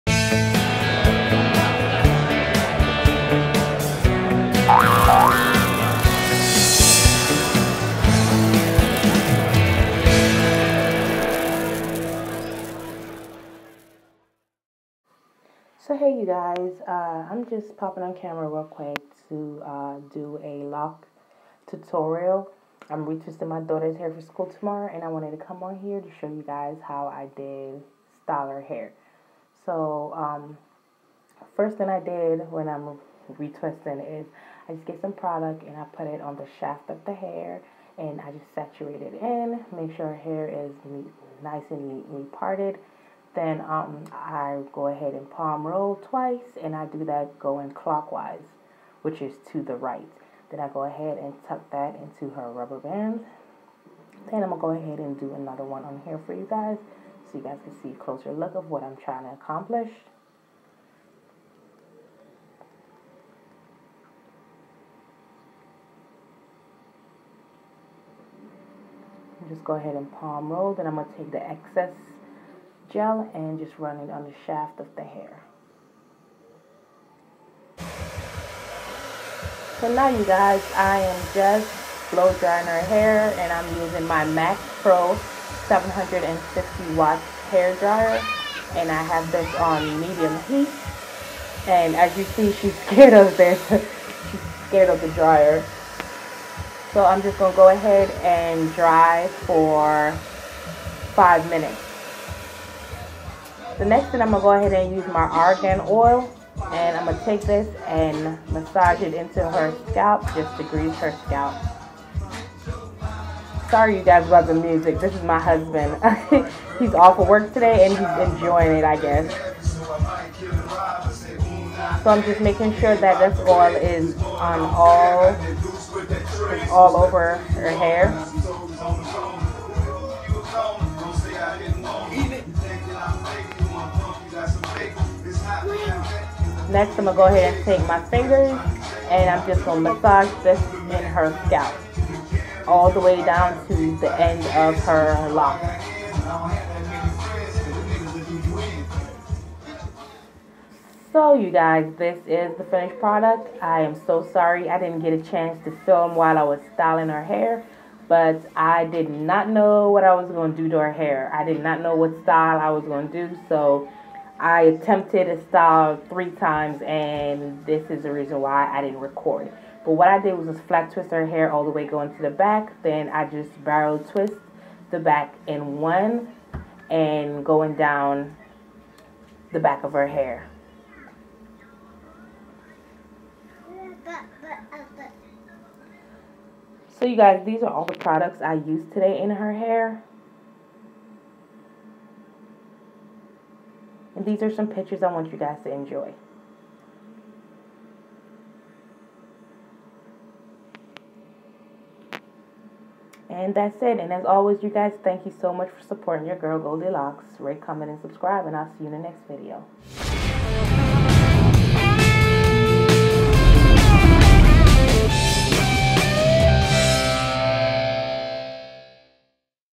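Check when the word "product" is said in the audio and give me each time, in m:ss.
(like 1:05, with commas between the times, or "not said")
0:35, 2:33, 3:07.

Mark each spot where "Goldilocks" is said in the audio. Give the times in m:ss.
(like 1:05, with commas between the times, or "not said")
3:26.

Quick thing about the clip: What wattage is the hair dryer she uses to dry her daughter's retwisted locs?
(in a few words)
750 watt.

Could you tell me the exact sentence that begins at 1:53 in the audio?
Sorry you guys about the music.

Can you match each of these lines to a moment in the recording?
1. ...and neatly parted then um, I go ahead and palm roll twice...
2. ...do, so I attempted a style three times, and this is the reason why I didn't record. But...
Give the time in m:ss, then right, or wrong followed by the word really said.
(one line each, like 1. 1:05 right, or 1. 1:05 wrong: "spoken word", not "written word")
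1. 0:41 right
2. 2:43 right.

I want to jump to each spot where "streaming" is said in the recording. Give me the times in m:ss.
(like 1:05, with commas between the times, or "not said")
not said.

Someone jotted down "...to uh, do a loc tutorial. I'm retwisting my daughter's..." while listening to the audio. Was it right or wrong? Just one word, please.
right.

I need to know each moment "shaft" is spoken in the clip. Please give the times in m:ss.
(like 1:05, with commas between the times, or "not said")
0:36, 1:14.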